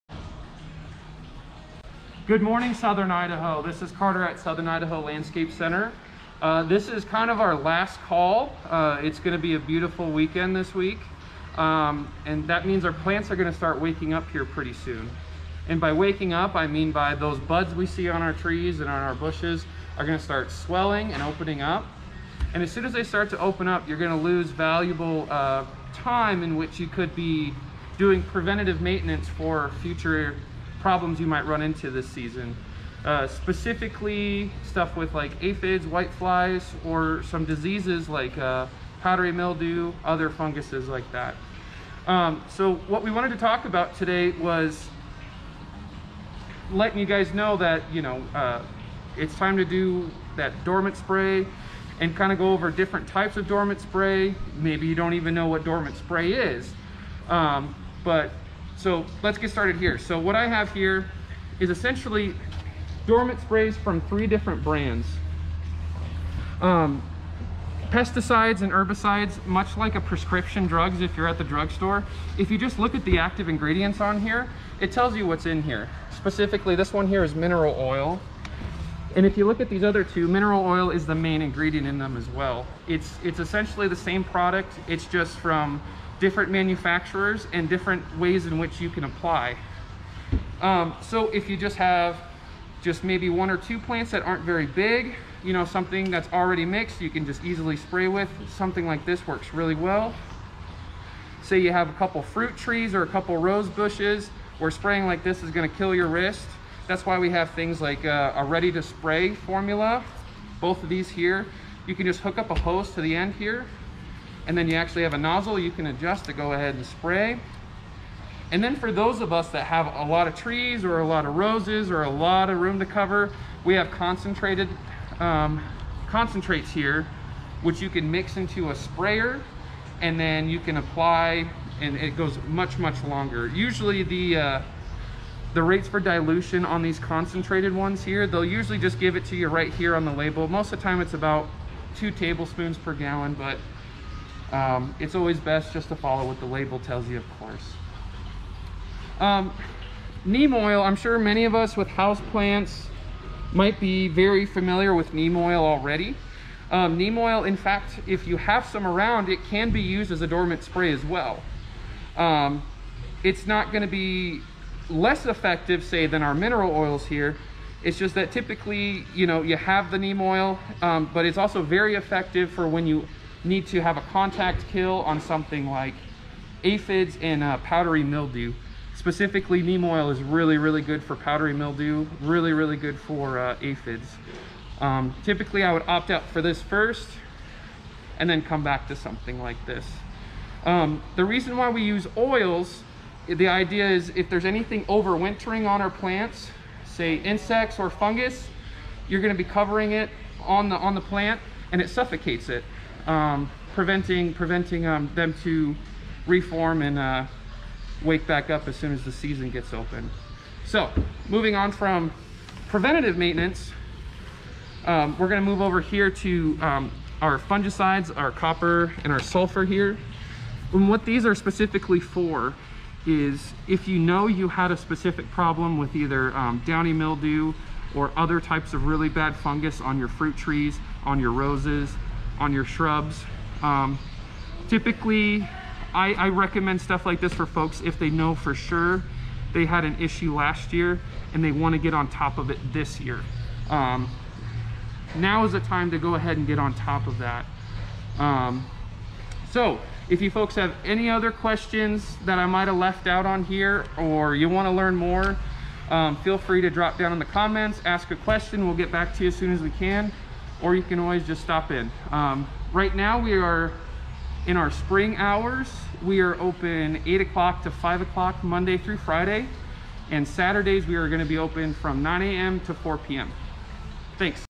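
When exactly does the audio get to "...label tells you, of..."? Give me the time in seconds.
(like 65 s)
146 s.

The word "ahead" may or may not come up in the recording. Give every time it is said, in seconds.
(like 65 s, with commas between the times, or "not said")
116 s, 246 s.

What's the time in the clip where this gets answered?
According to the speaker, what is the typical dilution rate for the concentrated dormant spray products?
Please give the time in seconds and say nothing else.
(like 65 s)
141 s.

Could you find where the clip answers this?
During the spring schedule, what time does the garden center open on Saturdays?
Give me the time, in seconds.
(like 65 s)
272 s.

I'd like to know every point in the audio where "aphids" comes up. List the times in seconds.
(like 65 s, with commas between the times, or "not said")
35 s, 176 s, 183 s.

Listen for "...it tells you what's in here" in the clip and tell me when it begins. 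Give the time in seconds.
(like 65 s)
74 s.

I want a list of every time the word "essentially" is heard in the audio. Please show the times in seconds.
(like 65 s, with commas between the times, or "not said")
61 s, 83 s.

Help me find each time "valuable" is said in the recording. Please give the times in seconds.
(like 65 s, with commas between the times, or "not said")
24 s.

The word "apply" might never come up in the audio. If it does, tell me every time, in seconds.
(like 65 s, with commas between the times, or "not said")
89 s, 130 s.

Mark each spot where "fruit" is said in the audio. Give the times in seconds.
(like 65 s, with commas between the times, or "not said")
102 s, 230 s.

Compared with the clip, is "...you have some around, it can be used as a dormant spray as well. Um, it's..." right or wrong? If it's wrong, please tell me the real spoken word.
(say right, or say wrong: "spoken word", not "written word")
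right.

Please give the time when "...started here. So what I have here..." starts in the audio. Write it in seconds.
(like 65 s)
59 s.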